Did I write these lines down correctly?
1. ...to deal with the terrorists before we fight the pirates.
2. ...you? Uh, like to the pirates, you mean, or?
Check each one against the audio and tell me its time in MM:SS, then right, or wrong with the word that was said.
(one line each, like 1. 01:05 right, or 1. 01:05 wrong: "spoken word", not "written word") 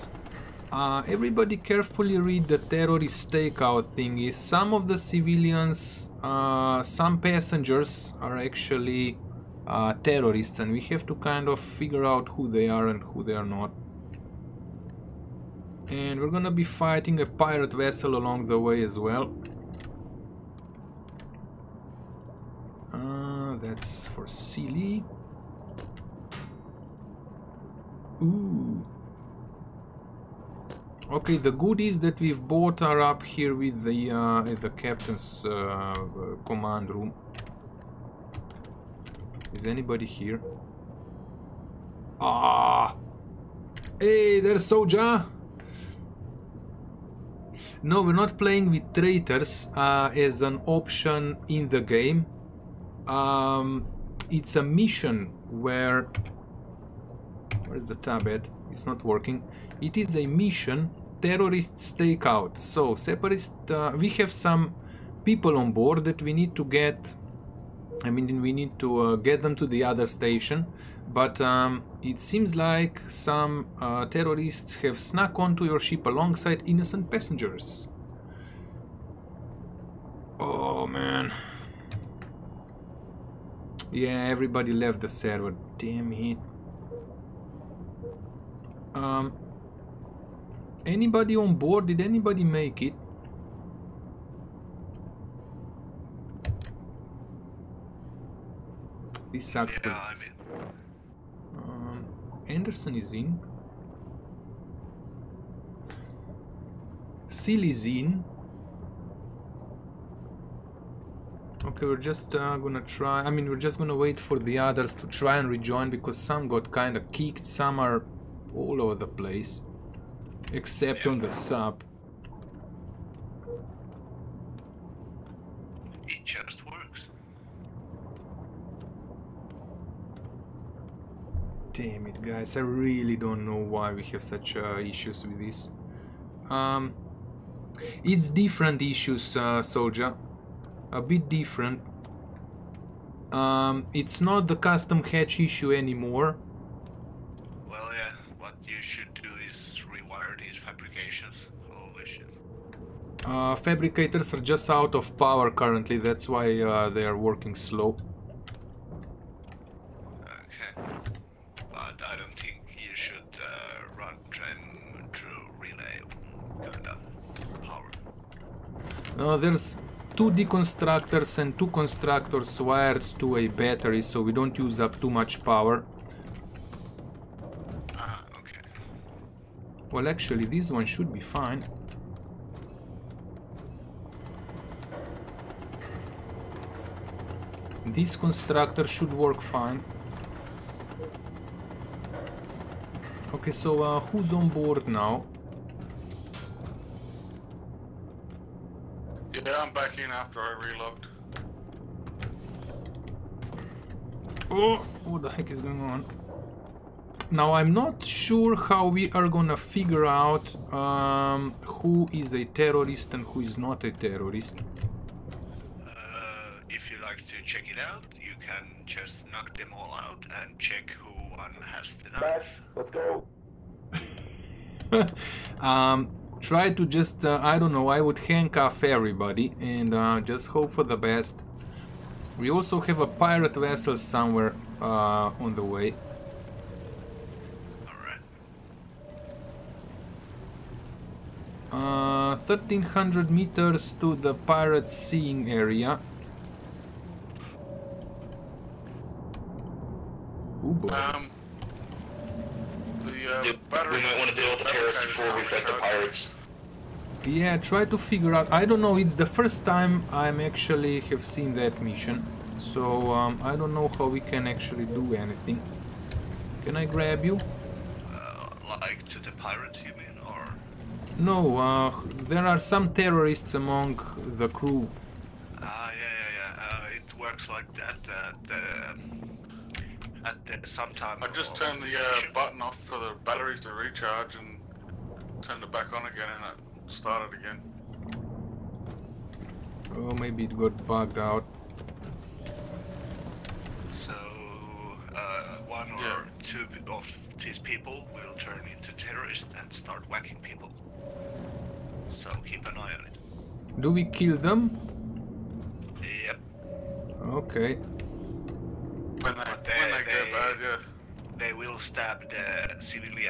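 1. 04:14 right
2. 04:27 right.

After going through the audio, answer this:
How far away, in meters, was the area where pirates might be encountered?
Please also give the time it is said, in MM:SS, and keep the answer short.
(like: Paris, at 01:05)
1300, at 04:02.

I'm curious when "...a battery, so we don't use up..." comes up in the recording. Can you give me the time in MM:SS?
02:53.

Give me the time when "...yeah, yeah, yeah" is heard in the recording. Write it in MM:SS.
04:35.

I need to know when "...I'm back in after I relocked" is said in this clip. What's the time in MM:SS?
03:19.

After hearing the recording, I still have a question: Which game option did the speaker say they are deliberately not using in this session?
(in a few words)
Traitors.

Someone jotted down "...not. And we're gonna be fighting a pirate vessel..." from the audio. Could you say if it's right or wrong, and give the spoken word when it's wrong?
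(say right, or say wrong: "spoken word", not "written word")
right.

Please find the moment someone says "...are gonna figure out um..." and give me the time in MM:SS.
03:29.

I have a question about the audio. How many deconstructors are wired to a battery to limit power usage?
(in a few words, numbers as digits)
2.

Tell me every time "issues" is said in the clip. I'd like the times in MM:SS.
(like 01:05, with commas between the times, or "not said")
02:14, 02:18, 02:25.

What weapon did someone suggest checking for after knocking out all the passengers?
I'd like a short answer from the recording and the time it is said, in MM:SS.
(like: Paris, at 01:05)
Knife, at 03:42.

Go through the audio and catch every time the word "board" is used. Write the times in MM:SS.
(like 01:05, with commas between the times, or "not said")
01:05, 01:31, 03:14.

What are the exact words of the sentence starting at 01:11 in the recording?
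But um, it seems like some uh, terrorists have snuck onto your ship alongside innocent passengers.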